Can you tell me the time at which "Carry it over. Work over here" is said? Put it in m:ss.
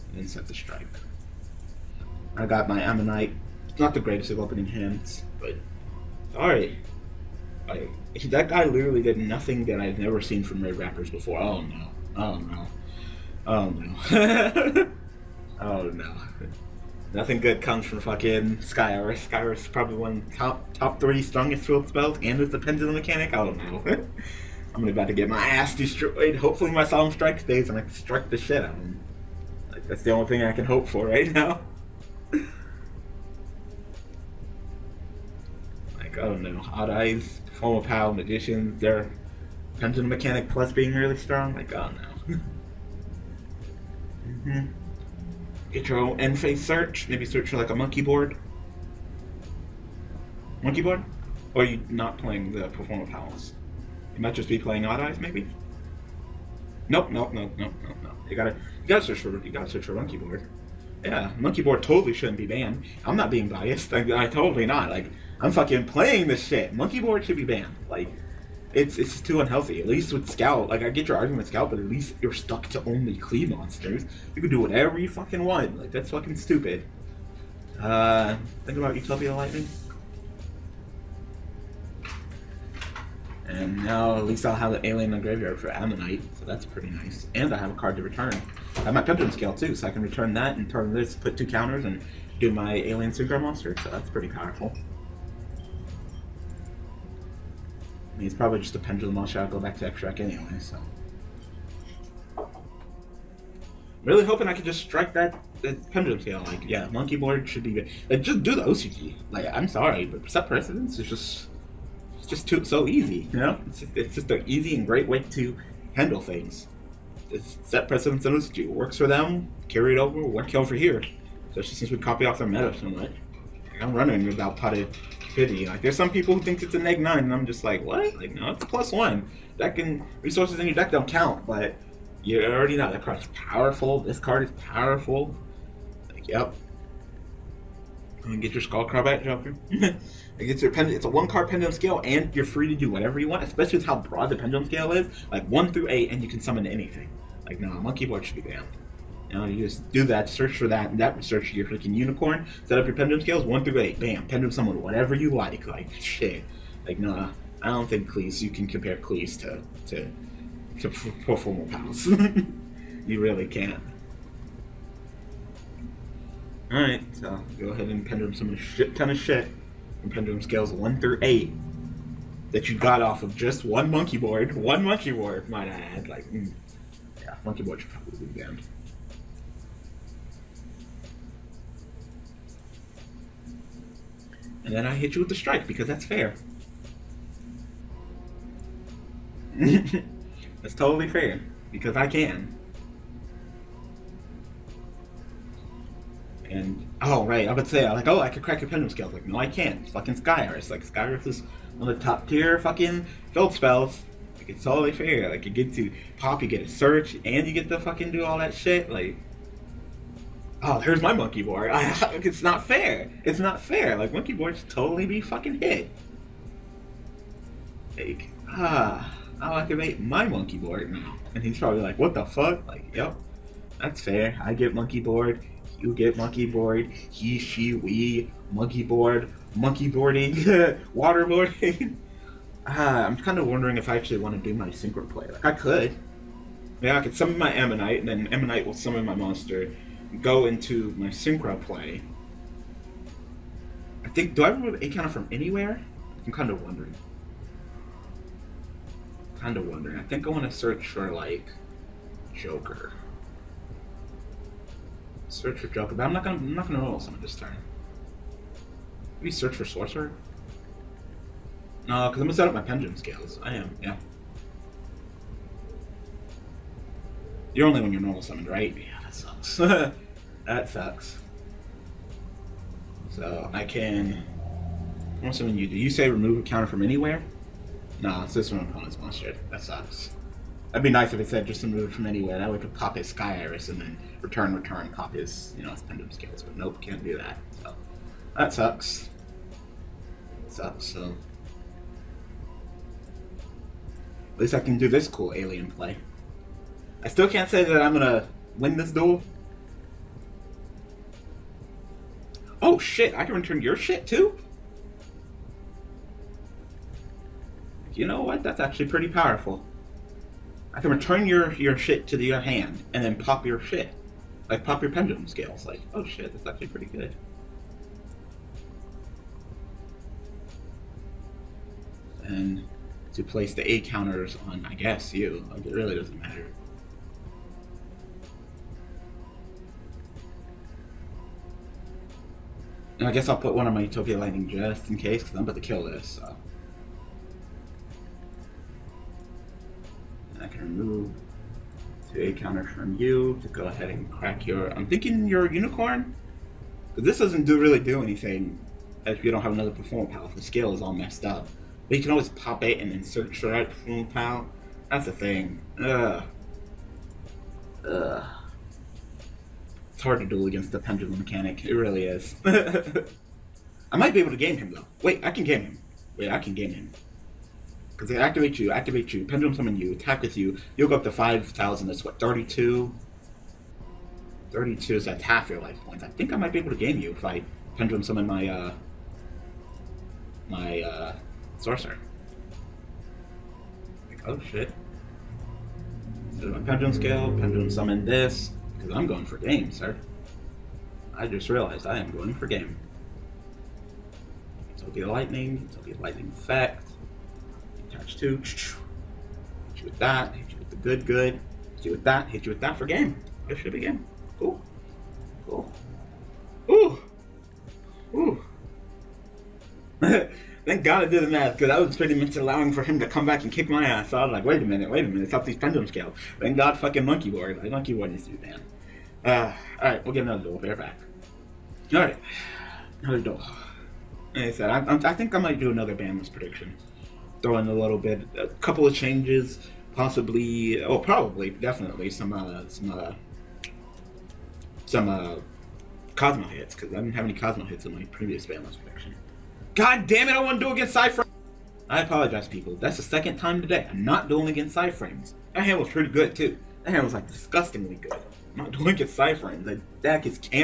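1:59.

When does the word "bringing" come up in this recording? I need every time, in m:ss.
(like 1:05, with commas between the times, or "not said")
not said.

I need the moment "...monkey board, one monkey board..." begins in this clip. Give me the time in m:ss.
2:53.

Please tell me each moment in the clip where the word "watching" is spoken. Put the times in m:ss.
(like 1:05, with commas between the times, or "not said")
not said.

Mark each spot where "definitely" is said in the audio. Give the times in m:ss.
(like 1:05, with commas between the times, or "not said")
7:11.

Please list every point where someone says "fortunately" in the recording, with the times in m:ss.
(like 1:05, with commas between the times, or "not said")
not said.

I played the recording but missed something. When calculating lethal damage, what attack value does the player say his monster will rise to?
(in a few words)
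5000.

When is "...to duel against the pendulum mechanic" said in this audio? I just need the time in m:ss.
6:00.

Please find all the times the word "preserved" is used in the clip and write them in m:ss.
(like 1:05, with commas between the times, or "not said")
not said.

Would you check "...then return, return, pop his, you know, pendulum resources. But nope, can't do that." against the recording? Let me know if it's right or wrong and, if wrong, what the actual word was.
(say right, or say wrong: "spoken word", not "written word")
wrong: "scales", not "resources".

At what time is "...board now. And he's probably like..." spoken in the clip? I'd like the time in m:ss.
3:40.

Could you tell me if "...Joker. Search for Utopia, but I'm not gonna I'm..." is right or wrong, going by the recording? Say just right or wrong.
wrong.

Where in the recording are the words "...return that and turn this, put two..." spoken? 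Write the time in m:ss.
1:30.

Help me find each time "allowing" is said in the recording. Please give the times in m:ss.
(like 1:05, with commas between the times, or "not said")
6:52.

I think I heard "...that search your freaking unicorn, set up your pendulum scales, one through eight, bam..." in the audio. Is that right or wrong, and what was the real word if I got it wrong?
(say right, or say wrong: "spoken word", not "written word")
right.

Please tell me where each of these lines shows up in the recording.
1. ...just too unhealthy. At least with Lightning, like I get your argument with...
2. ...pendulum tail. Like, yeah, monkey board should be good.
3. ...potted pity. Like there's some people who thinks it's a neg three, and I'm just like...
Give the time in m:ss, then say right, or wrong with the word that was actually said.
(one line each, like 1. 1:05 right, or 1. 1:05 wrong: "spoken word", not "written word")
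1. 1:09 wrong: "Scout", not "Lightning"
2. 1:45 right
3. 2:04 wrong: "nine", not "three".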